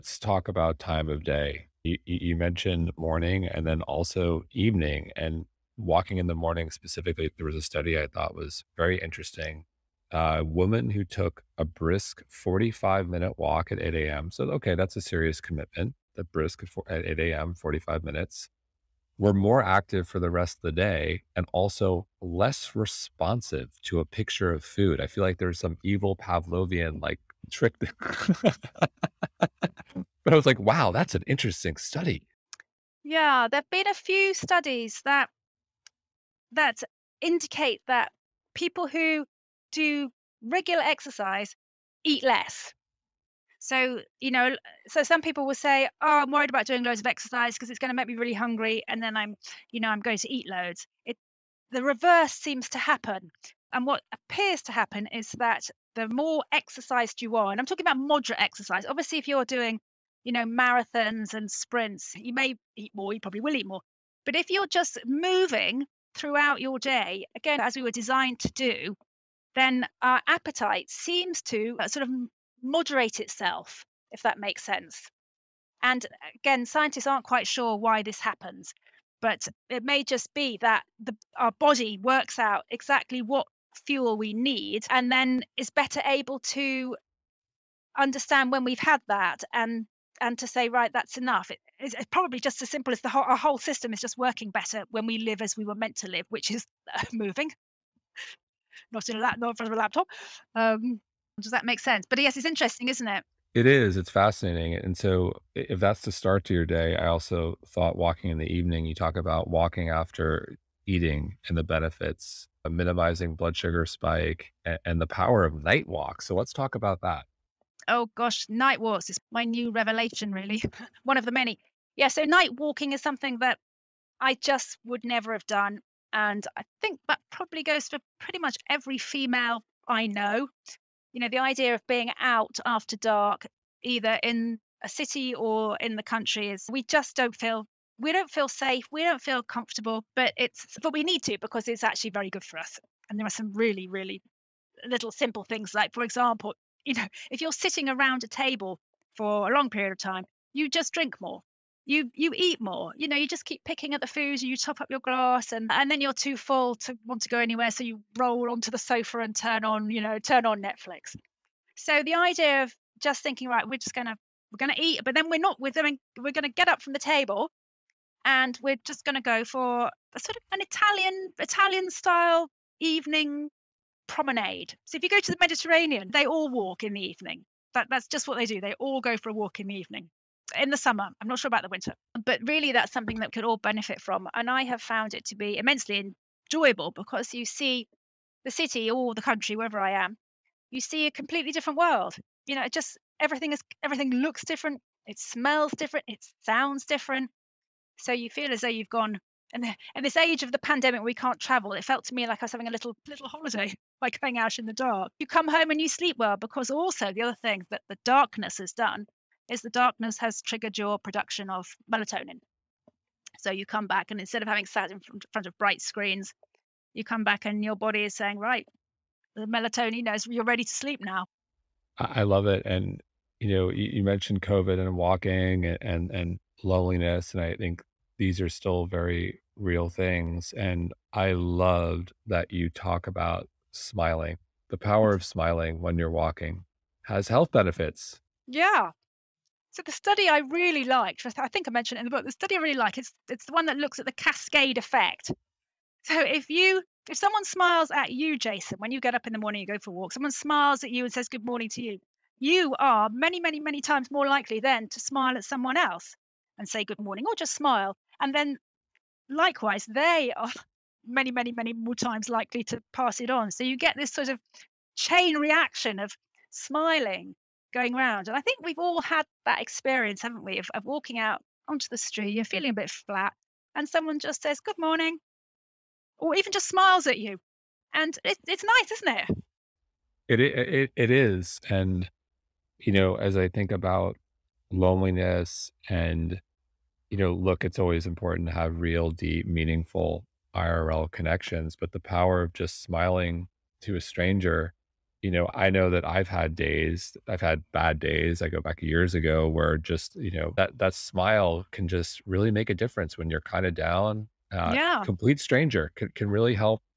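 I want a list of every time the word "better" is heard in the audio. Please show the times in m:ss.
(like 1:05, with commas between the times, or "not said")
1:25, 1:34.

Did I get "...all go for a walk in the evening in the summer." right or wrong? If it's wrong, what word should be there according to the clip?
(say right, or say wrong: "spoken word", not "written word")
right.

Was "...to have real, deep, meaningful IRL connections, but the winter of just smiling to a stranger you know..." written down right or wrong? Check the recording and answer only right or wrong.
wrong.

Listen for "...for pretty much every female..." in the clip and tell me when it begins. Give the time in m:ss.
2:07.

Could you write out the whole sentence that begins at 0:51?
It, the reverse seems to happen.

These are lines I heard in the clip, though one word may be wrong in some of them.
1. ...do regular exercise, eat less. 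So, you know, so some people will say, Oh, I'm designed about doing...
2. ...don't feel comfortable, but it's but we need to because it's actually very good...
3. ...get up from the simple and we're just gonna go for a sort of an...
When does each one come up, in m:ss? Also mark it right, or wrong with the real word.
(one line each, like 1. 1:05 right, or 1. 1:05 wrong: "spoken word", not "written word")
1. 0:39 wrong: "worried", not "designed"
2. 2:19 right
3. 2:46 wrong: "table", not "simple".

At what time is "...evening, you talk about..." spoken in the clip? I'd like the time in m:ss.
1:48.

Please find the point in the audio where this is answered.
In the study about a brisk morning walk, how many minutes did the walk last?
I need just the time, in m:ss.
0:12.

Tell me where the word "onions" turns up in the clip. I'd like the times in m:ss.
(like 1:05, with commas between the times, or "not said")
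not said.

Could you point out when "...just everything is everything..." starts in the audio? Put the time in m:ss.
3:12.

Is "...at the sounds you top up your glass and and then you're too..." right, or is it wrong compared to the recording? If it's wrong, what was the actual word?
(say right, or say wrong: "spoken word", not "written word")
wrong: "foods", not "sounds".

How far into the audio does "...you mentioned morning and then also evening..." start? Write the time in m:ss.
0:02.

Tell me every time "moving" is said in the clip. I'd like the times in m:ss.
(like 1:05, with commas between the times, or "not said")
1:05, 1:37.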